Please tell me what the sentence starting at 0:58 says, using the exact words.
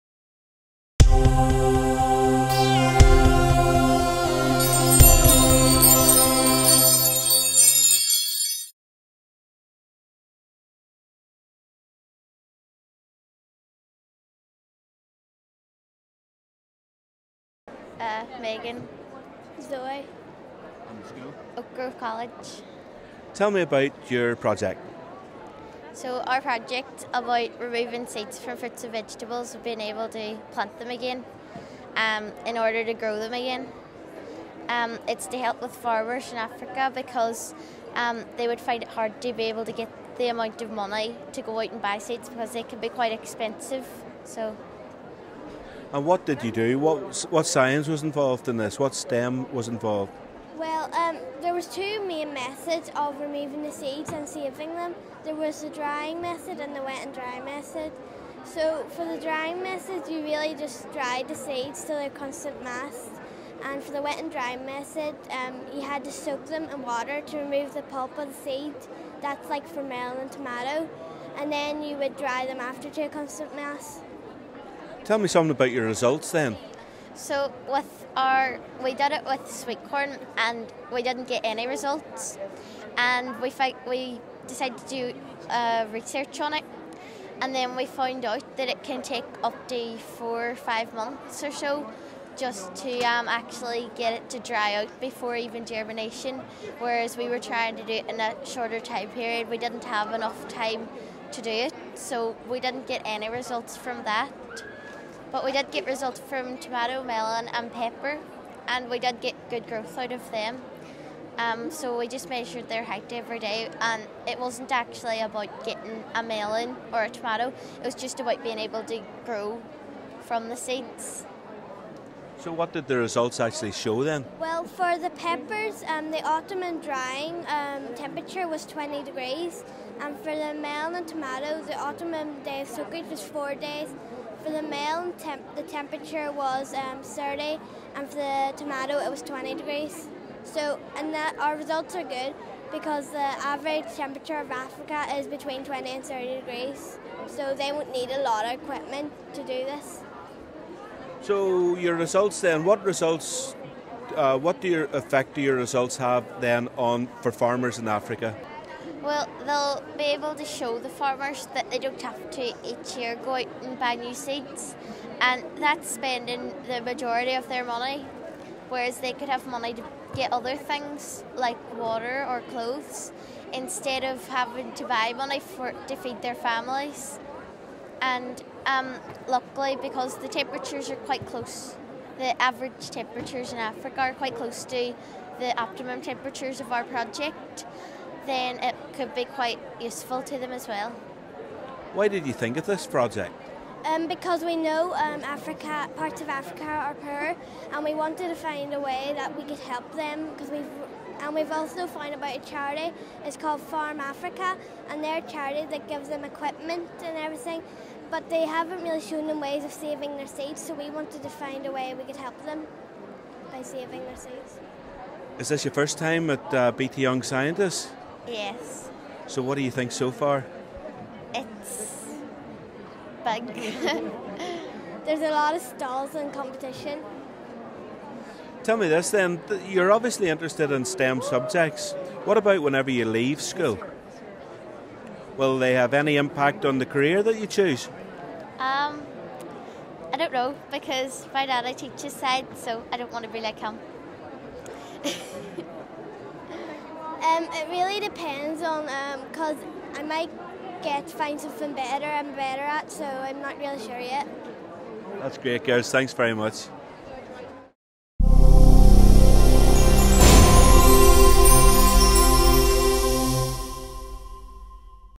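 So for the drying method, you really just dried the seeds till they're constant mass.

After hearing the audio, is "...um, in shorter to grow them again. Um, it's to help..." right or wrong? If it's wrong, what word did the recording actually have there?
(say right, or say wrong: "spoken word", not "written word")
wrong: "order", not "shorter".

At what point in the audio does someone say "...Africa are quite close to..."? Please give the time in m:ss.
3:03.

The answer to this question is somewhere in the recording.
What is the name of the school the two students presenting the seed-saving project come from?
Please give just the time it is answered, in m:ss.
0:21.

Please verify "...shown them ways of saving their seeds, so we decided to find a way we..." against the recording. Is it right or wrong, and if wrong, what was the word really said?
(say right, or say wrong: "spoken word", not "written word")
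wrong: "wanted", not "decided".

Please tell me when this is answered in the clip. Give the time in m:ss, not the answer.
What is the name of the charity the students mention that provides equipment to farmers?
3:23.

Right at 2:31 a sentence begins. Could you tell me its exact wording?
So your results then, what results, uh, what do your effect do your results have then on for farmers in Africa?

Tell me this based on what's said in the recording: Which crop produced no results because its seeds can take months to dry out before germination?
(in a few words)
Sweet corn.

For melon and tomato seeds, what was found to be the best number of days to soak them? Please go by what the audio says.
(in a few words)
4 days.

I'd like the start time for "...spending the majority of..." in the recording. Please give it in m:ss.
2:45.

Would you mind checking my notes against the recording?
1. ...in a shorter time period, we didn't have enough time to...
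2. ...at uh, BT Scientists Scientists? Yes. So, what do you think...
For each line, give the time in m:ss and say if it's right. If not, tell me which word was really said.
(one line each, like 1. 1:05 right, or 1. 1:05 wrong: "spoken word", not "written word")
1. 1:38 right
2. 3:36 wrong: "Young", not "Scientists".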